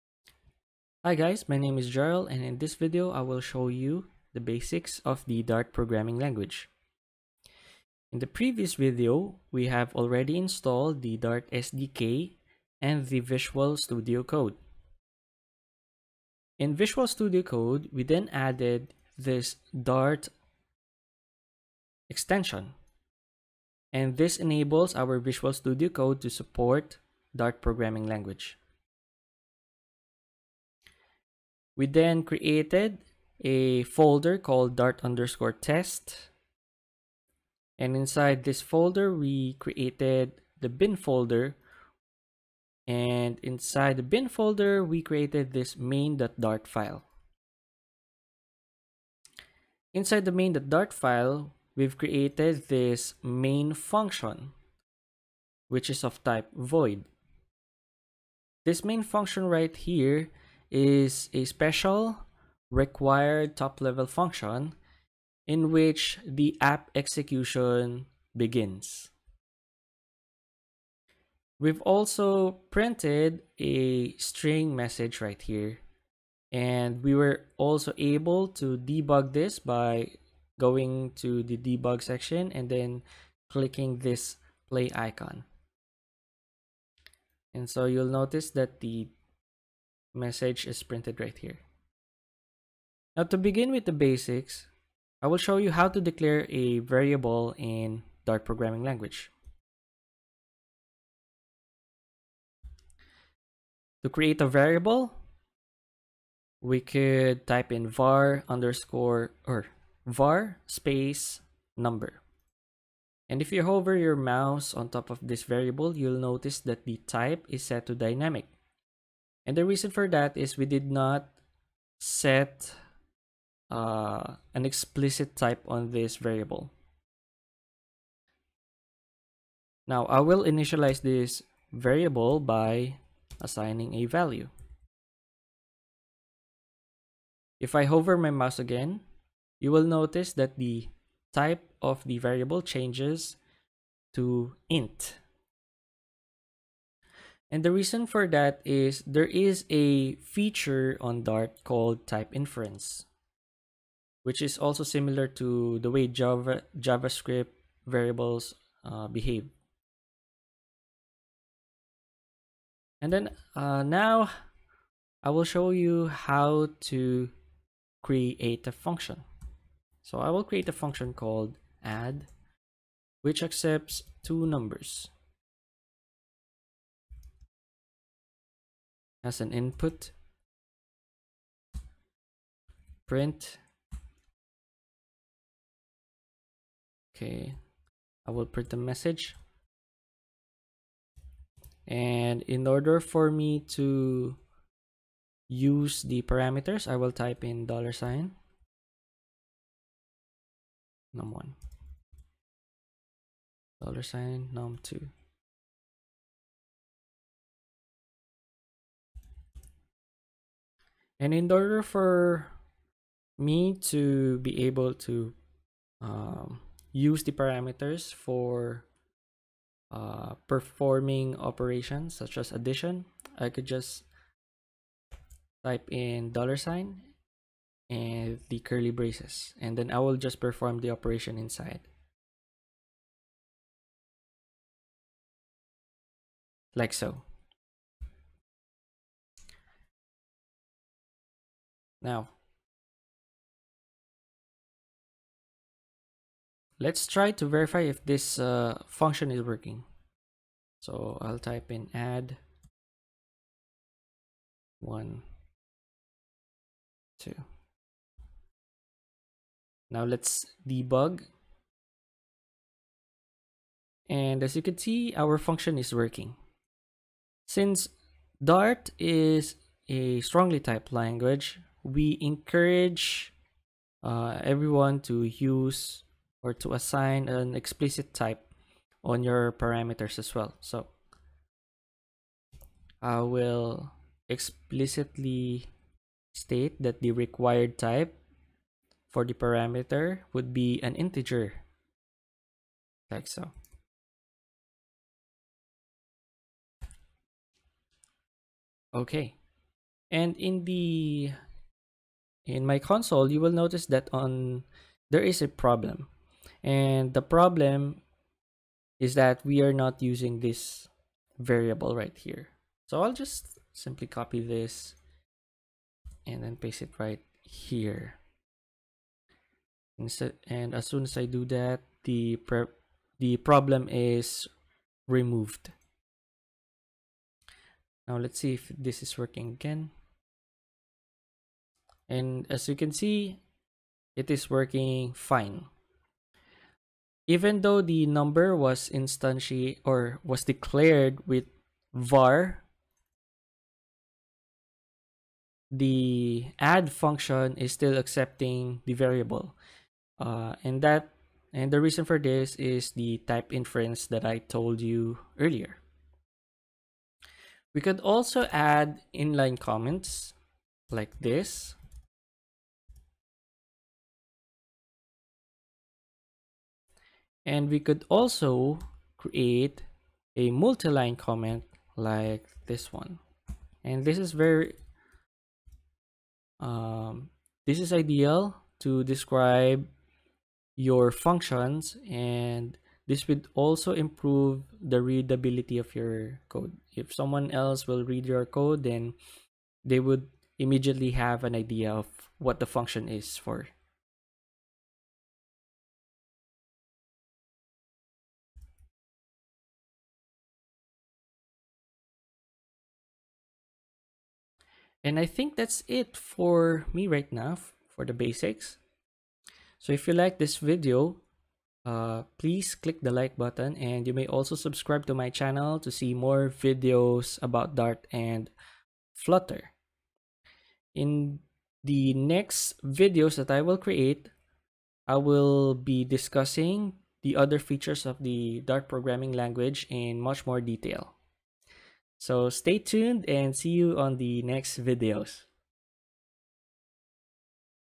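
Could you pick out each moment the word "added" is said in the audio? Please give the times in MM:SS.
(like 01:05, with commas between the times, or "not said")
00:18.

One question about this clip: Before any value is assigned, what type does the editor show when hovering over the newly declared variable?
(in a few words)
dynamic.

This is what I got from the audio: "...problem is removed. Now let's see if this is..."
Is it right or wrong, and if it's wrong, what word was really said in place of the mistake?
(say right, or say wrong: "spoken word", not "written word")
right.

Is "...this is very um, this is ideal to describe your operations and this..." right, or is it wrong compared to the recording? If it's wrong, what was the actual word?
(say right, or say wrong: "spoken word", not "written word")
wrong: "functions", not "operations".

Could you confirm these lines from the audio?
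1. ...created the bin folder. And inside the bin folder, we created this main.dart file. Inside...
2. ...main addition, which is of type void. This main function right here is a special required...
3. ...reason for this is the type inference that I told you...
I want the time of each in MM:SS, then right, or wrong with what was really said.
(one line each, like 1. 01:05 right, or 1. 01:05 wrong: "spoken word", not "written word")
1. 00:39 right
2. 00:53 wrong: "function", not "addition"
3. 05:51 right.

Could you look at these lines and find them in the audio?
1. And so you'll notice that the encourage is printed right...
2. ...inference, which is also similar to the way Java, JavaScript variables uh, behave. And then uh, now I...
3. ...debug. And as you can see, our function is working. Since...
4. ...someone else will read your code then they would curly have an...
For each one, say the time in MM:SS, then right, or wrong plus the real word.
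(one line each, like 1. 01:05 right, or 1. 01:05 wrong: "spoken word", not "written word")
1. 01:27 wrong: "message", not "encourage"
2. 02:32 right
3. 04:20 right
4. 06:27 wrong: "immediately", not "curly".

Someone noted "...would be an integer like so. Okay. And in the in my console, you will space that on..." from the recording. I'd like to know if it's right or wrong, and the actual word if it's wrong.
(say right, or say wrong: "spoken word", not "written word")
wrong: "notice", not "space".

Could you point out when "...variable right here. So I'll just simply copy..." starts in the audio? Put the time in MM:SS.
05:11.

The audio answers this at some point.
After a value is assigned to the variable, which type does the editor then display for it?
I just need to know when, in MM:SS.
02:24.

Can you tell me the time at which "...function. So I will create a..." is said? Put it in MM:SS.
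02:48.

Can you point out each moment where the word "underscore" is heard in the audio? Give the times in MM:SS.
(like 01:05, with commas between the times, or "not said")
00:35, 01:48.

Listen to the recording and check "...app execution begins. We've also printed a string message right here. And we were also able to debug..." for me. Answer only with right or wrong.
right.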